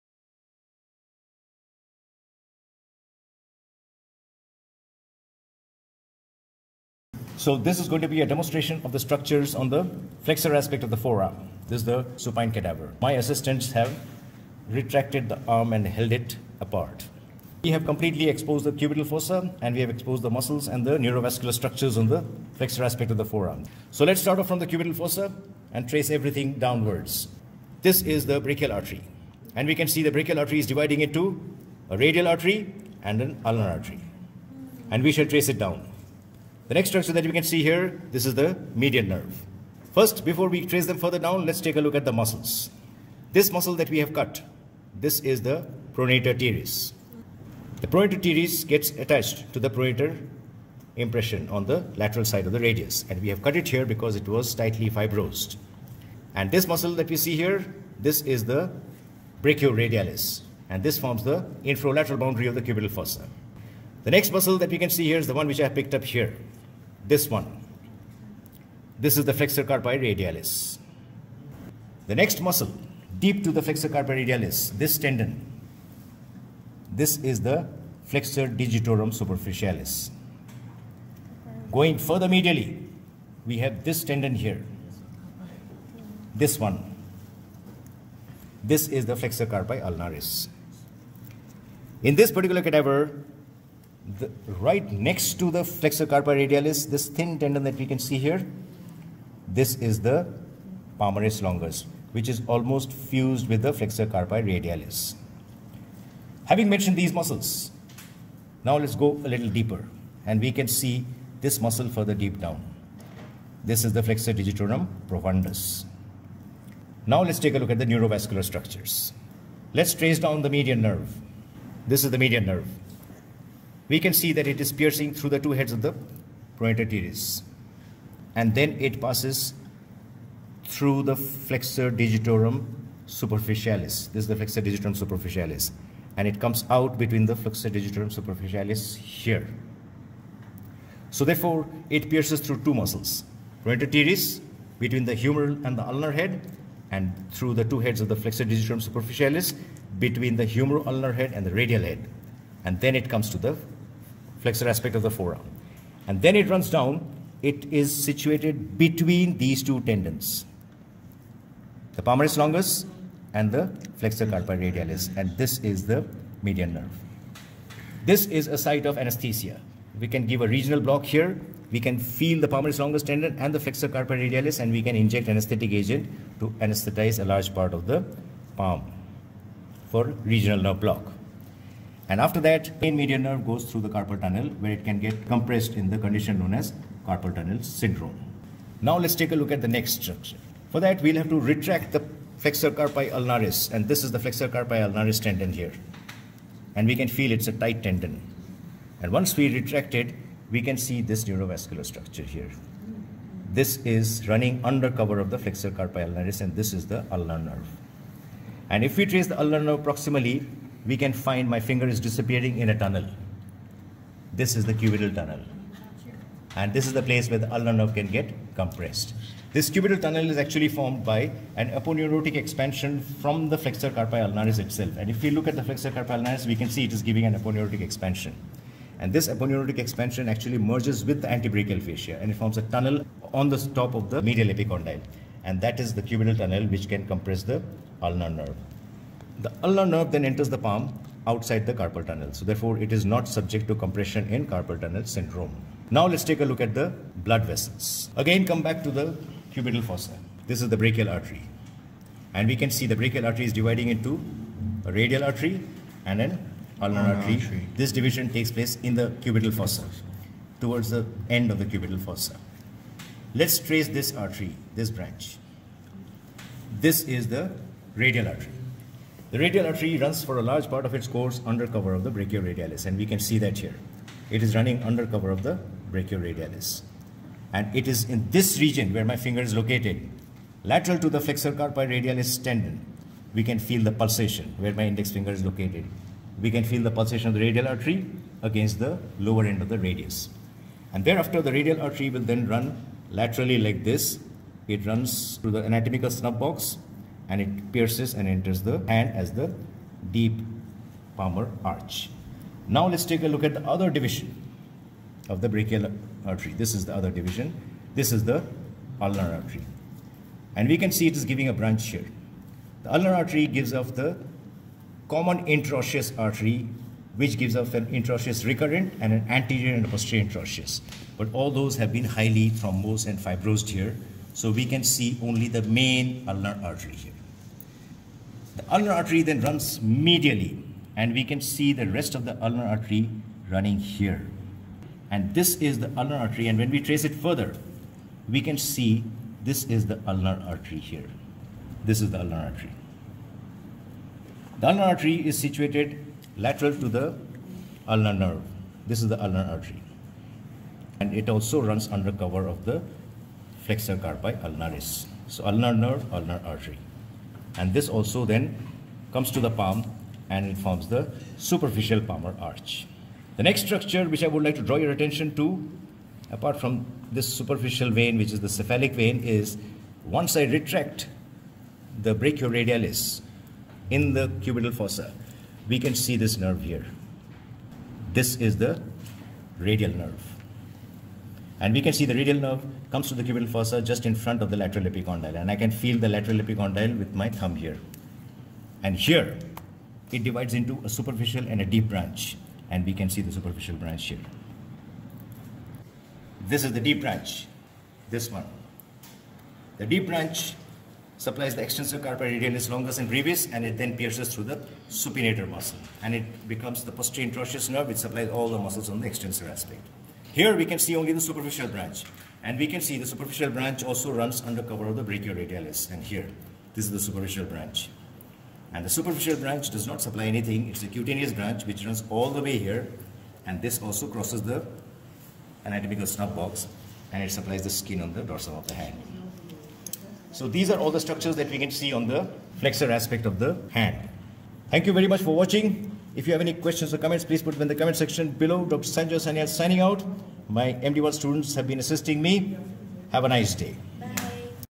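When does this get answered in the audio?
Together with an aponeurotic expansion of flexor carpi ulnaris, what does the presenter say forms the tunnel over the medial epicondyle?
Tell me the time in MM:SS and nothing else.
03:51.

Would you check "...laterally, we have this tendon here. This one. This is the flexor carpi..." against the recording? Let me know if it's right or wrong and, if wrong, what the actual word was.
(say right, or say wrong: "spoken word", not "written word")
wrong: "medially", not "laterally".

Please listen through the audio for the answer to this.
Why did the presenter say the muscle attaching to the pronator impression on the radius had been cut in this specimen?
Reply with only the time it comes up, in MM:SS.
00:54.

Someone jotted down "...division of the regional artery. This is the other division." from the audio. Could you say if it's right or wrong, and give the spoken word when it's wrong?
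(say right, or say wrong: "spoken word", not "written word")
wrong: "brachial", not "regional".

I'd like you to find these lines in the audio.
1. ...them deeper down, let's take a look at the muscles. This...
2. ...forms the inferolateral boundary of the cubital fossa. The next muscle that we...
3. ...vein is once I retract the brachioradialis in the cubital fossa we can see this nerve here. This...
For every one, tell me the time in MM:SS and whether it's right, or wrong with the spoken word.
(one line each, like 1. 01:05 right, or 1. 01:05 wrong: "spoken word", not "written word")
1. 00:40 wrong: "further", not "deeper"
2. 01:00 right
3. 06:08 right.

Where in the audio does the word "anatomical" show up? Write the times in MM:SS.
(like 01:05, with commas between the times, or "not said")
04:55, 07:05.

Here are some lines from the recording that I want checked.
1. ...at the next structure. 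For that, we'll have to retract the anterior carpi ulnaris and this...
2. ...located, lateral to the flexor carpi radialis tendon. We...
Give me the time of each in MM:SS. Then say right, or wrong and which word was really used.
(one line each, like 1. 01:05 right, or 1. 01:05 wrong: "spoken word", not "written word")
1. 03:09 wrong: "flexor", not "anterior"
2. 04:39 right.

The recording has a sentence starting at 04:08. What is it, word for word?
Again, come back to the cubital fossa.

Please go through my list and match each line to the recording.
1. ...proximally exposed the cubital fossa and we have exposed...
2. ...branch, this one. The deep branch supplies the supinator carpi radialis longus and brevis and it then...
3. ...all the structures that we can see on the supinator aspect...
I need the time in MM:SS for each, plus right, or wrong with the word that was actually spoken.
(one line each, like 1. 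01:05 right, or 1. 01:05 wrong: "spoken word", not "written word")
1. 00:17 wrong: "completely", not "proximally"
2. 06:37 wrong: "extensor", not "supinator"
3. 07:10 wrong: "flexor", not "supinator".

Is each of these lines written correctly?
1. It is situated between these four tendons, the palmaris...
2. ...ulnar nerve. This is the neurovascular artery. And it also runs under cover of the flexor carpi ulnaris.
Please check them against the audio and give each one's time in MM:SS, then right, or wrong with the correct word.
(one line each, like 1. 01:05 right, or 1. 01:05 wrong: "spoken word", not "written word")
1. 02:37 wrong: "two", not "four"
2. 05:47 wrong: "ulnar", not "neurovascular".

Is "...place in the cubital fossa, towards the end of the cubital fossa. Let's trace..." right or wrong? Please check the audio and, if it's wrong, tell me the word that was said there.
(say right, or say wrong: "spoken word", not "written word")
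right.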